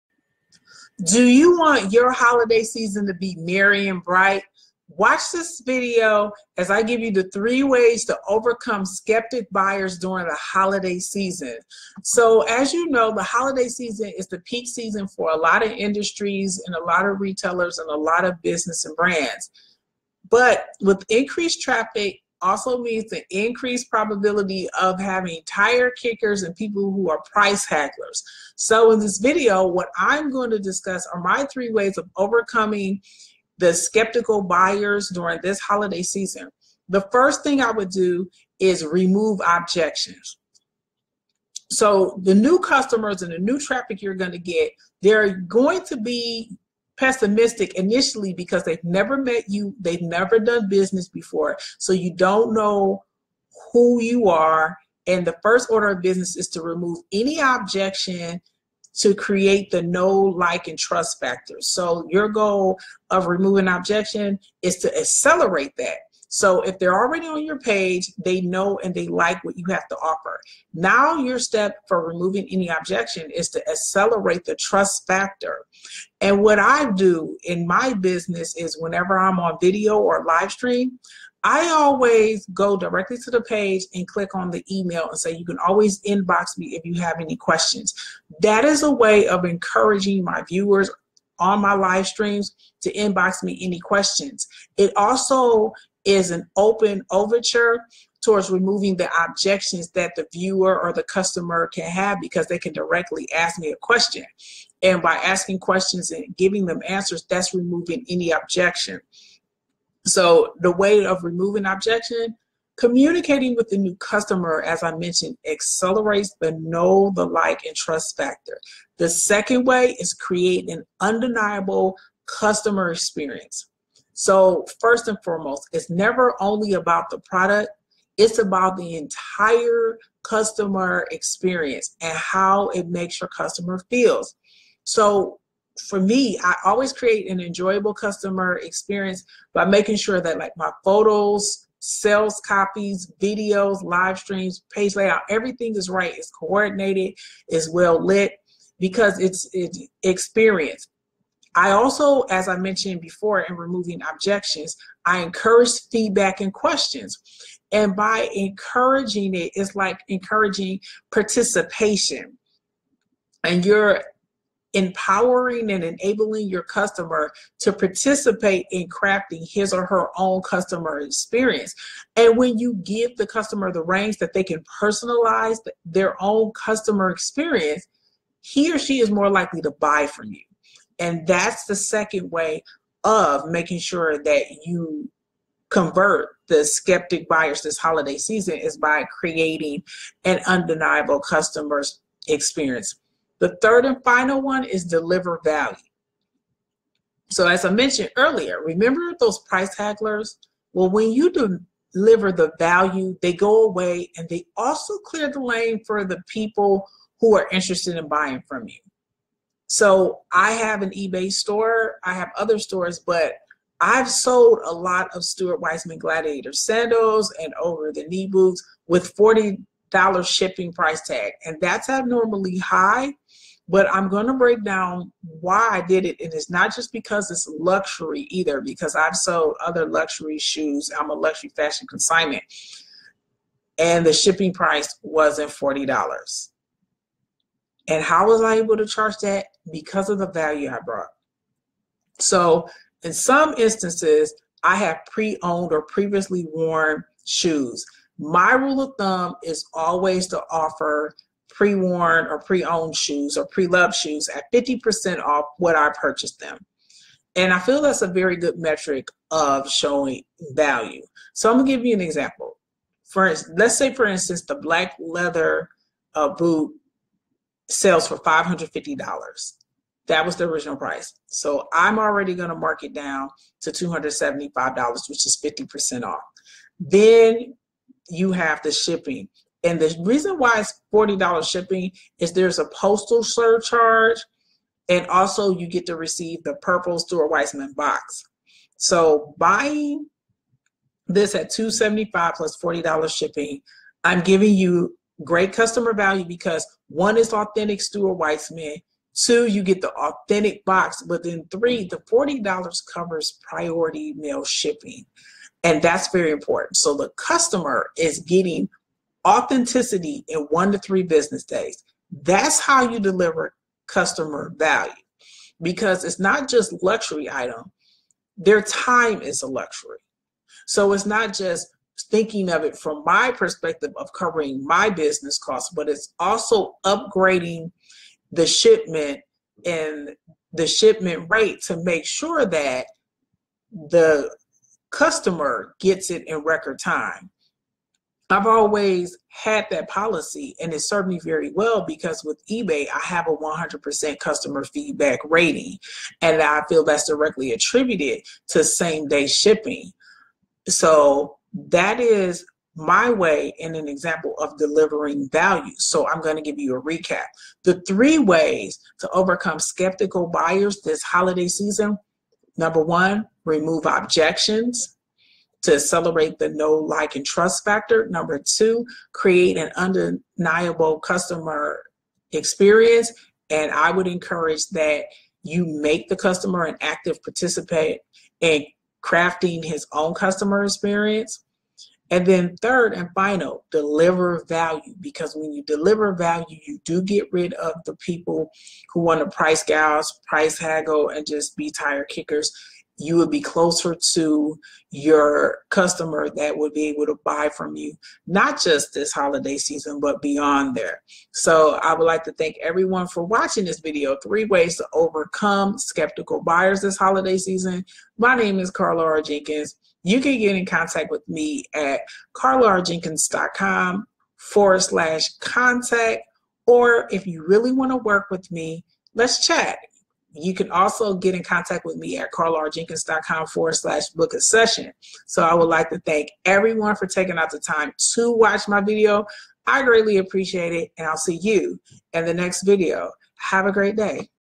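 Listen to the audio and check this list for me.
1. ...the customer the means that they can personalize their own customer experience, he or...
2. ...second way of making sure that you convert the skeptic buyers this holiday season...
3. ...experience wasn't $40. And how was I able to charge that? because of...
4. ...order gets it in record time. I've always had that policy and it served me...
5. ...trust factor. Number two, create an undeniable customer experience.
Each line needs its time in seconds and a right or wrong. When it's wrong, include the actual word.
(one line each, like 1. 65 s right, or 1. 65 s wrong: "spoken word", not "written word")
1. 173 s wrong: "reins", not "means"
2. 181 s right
3. 234 s wrong: "price", not "experience"
4. 334 s wrong: "customer", not "order"
5. 367 s right.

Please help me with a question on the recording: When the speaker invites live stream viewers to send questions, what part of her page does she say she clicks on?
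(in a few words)
email.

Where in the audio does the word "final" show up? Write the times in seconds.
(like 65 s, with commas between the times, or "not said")
194 s, 383 s.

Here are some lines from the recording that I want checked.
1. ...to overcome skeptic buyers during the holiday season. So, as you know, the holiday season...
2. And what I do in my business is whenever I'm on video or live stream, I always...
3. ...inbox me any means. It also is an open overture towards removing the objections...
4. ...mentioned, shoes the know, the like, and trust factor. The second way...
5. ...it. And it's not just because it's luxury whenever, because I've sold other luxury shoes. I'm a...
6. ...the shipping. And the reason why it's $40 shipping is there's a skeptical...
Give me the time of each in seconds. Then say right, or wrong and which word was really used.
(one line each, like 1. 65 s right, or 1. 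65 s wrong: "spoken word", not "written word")
1. 8 s right
2. 76 s right
3. 92 s wrong: "questions", not "means"
4. 114 s wrong: "accelerates", not "shoes"
5. 226 s wrong: "either", not "whenever"
6. 278 s wrong: "postal", not "skeptical".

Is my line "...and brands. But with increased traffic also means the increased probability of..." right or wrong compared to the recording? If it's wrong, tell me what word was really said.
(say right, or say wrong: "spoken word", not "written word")
right.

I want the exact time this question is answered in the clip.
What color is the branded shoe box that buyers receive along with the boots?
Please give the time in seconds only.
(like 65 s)
286 s.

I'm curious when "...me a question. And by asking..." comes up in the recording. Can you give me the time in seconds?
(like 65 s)
103 s.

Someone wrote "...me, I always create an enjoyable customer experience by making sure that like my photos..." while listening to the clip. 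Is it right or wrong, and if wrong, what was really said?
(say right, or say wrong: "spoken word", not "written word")
right.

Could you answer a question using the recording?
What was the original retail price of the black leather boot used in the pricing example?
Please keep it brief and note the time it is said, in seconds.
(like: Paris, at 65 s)
$550, at 268 s.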